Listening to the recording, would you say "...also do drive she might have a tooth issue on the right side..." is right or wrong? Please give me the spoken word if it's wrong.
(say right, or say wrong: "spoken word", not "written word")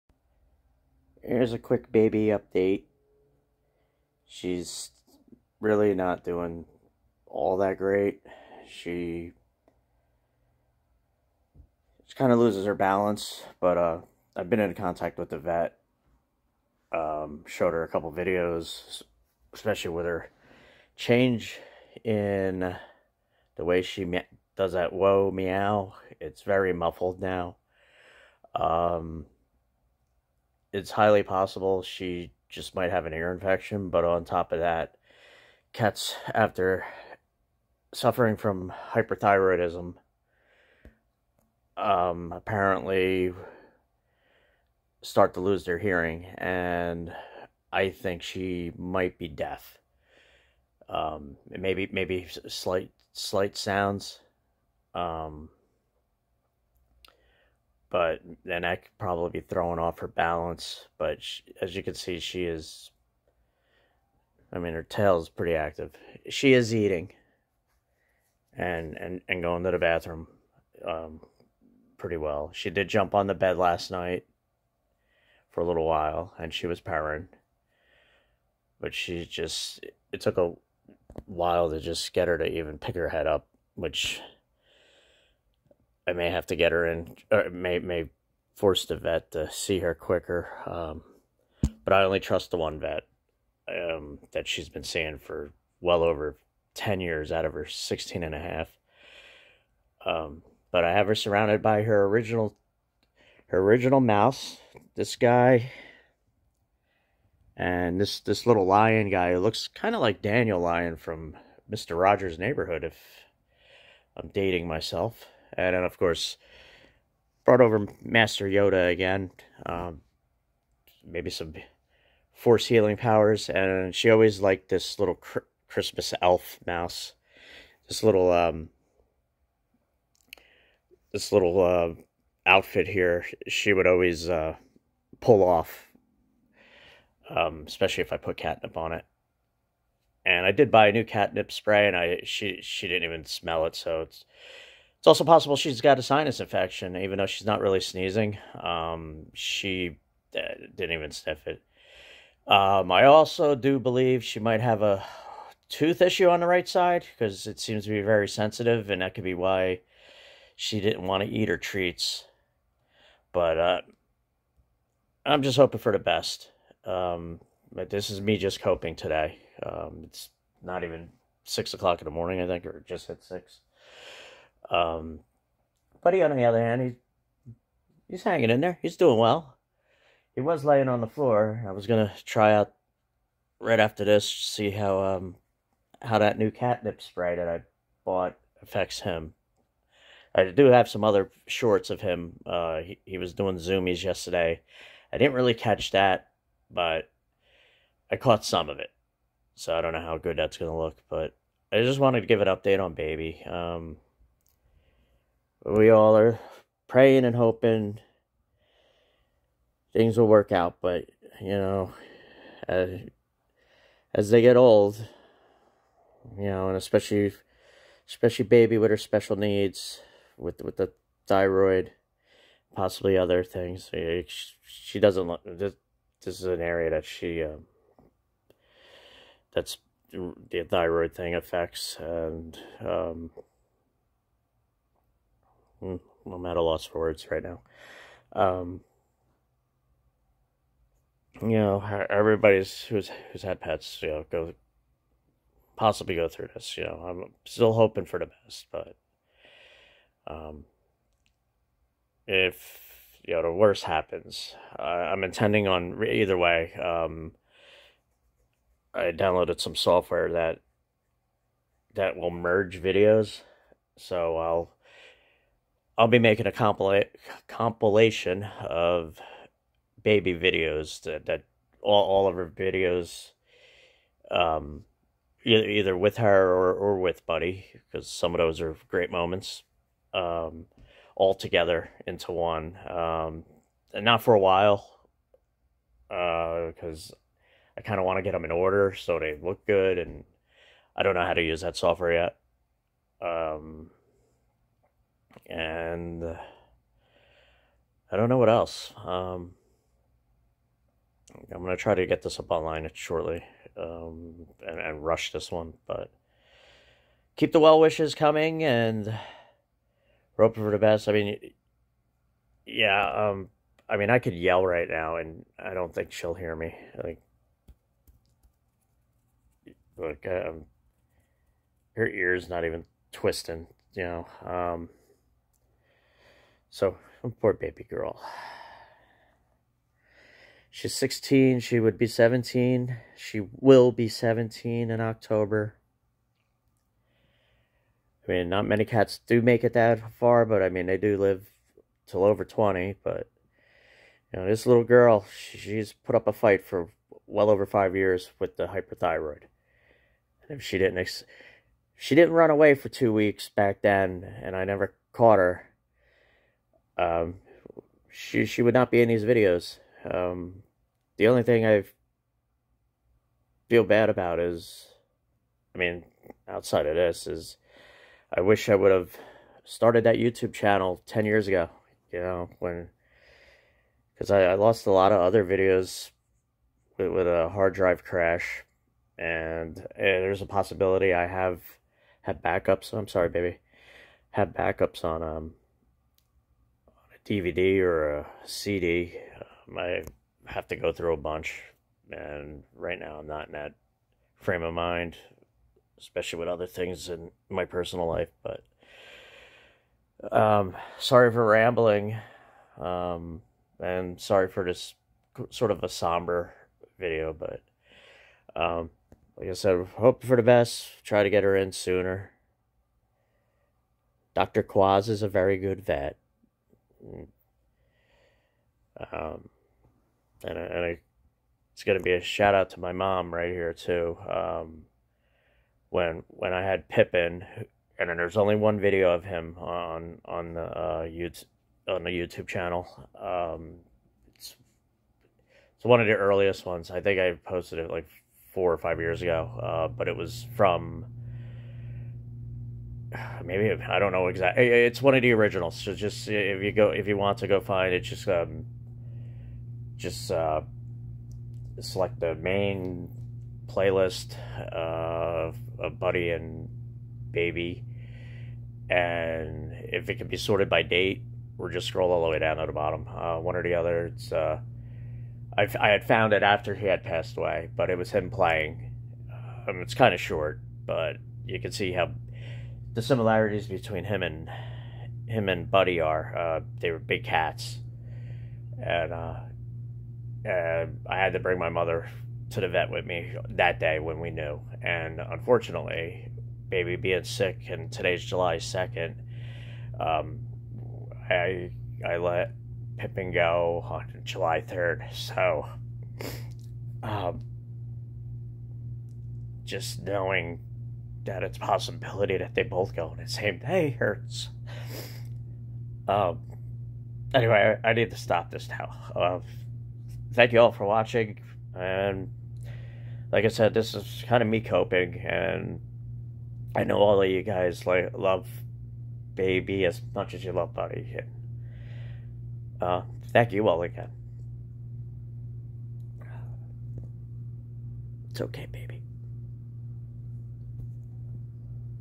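wrong: "believe", not "drive".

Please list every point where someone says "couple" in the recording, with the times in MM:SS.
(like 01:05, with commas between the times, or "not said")
00:17.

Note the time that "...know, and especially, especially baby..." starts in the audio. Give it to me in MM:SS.
03:36.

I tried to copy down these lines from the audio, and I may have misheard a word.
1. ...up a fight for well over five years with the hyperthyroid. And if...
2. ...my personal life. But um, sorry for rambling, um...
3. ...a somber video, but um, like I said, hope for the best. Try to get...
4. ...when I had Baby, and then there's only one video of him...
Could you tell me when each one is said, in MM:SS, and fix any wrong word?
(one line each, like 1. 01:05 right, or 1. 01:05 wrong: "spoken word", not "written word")
1. 05:46 right
2. 06:37 right
3. 06:45 right
4. 07:06 wrong: "Pippin", not "Baby".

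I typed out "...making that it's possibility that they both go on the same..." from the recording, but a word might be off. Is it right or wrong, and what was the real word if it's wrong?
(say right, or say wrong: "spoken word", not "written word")
wrong: "knowing", not "making".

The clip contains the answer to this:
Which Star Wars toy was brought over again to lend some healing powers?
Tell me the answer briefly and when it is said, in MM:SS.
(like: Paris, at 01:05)
Master Yoda, at 01:58.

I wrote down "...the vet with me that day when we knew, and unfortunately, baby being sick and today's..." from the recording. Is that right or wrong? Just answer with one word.
right.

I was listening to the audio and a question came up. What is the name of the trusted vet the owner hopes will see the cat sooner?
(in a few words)
Dr. Quaz.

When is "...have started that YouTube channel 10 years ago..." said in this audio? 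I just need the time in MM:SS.
06:08.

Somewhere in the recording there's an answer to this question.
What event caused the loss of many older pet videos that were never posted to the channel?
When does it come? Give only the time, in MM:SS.
06:17.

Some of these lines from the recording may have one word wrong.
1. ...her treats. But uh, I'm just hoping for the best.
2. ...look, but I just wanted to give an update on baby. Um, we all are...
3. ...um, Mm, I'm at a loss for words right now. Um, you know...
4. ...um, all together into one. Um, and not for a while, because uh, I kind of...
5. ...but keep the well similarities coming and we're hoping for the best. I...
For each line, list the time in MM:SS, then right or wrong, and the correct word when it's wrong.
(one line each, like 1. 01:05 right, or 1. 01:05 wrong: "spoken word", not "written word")
1. 02:41 right
2. 03:20 right
3. 03:52 right
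4. 04:40 right
5. 05:05 wrong: "wishes", not "similarities".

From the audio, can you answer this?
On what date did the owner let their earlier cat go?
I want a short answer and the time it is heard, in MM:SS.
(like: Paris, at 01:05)
July 3, at 08:14.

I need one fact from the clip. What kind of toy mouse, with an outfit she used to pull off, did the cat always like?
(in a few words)
Christmas elf mouse.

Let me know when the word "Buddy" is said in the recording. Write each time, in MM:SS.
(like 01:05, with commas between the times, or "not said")
02:56, 04:37, 07:35, 07:55, 08:40.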